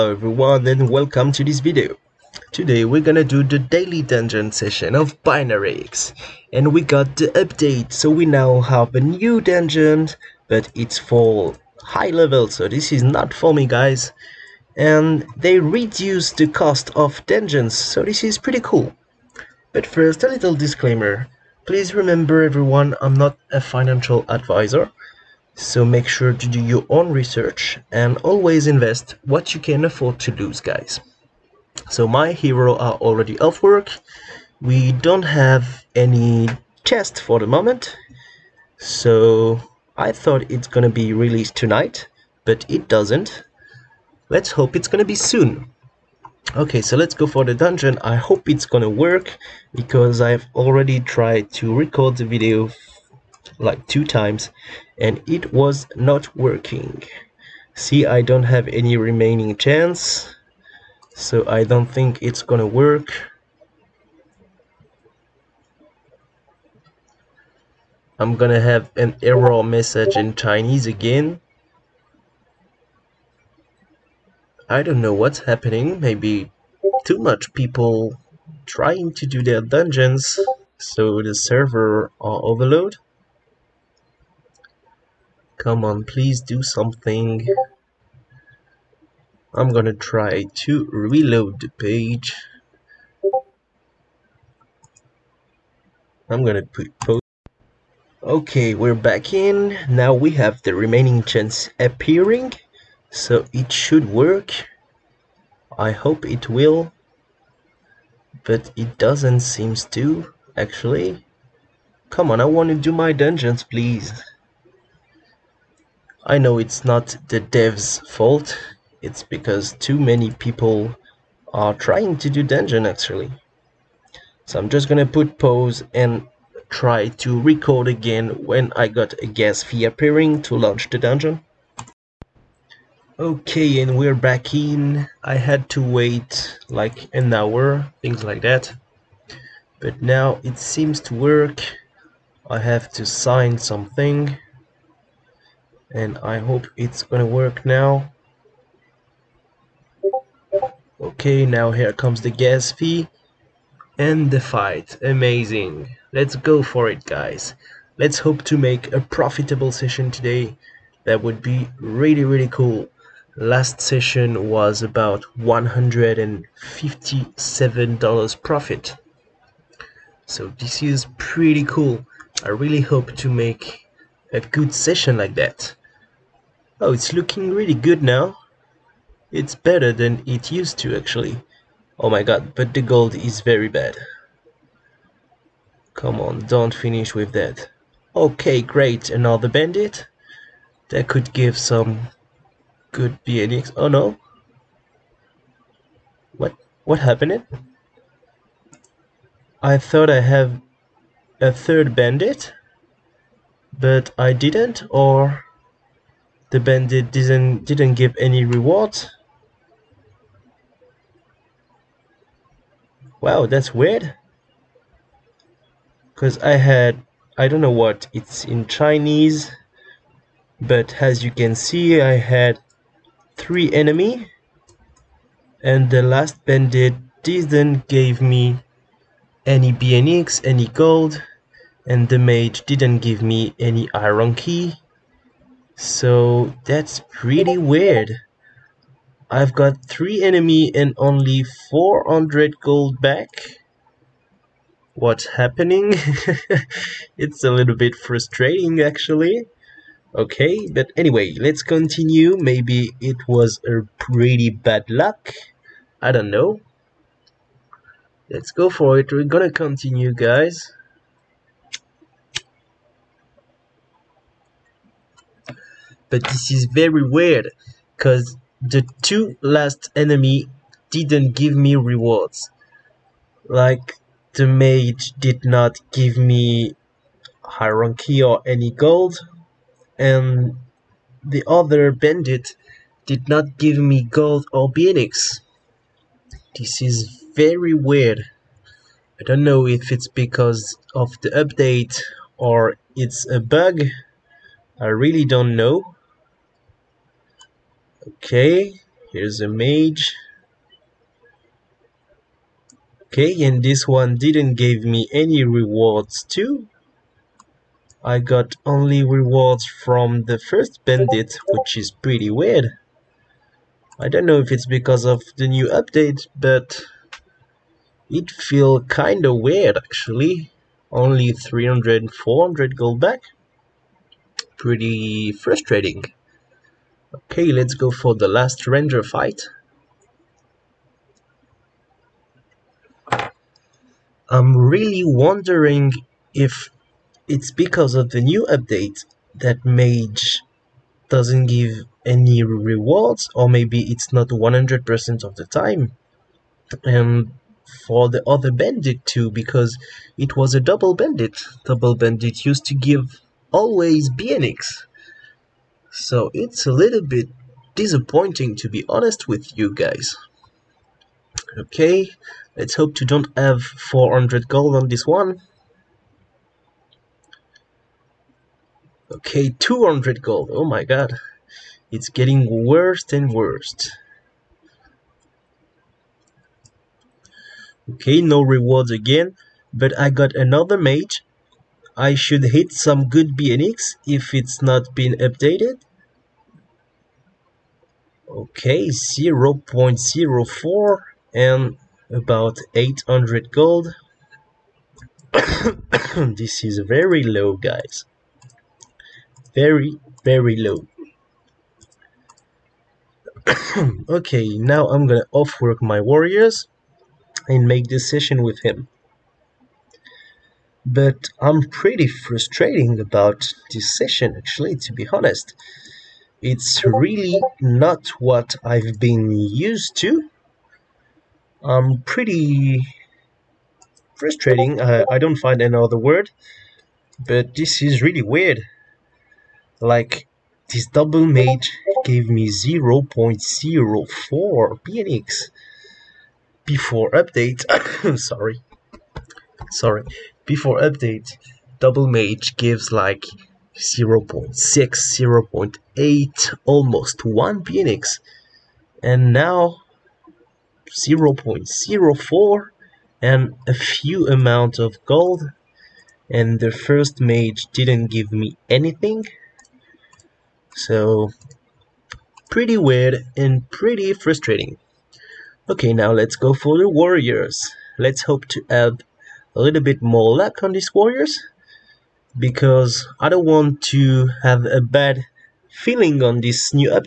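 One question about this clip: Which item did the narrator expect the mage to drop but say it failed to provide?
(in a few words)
iron key.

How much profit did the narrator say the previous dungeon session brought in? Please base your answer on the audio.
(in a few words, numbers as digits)
$157.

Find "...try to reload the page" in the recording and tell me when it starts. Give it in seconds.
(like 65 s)
89 s.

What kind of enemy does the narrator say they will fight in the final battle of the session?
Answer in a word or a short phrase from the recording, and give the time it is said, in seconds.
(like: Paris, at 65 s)
ranger, at 328 s.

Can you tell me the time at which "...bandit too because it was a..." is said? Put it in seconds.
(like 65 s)
348 s.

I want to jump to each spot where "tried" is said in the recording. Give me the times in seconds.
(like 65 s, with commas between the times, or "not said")
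50 s.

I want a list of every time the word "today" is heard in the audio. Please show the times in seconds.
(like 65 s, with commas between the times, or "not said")
2 s, 160 s.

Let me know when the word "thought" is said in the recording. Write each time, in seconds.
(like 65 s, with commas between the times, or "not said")
40 s, 199 s.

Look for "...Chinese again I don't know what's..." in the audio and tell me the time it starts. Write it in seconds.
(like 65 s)
70 s.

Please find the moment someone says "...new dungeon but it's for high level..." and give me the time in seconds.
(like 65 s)
9 s.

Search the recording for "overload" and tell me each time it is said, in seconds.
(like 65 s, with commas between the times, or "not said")
82 s.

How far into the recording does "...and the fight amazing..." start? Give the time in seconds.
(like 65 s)
153 s.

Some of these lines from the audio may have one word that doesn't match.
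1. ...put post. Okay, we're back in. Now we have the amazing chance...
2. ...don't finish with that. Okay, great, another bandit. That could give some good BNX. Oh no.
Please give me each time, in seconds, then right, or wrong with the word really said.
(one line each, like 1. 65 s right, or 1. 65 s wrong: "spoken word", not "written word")
1. 96 s wrong: "remaining", not "amazing"
2. 186 s right.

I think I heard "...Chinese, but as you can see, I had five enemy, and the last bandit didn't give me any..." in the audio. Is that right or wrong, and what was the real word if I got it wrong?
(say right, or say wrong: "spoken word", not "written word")
wrong: "three", not "five".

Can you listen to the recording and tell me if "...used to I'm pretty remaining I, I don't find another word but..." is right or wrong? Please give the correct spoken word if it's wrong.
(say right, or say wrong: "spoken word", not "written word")
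wrong: "frustrating", not "remaining".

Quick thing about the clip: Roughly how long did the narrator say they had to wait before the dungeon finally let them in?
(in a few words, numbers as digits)
an hour.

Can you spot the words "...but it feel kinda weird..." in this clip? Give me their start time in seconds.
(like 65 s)
316 s.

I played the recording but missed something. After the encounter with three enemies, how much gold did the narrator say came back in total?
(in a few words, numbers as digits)
400 gold.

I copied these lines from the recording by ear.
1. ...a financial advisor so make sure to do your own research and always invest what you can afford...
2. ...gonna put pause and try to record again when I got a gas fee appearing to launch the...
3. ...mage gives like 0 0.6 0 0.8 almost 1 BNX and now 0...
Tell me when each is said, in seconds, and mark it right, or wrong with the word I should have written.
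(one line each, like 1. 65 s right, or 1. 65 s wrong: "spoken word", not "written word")
1. 23 s right
2. 124 s right
3. 442 s right.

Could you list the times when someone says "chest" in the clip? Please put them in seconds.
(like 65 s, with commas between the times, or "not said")
36 s.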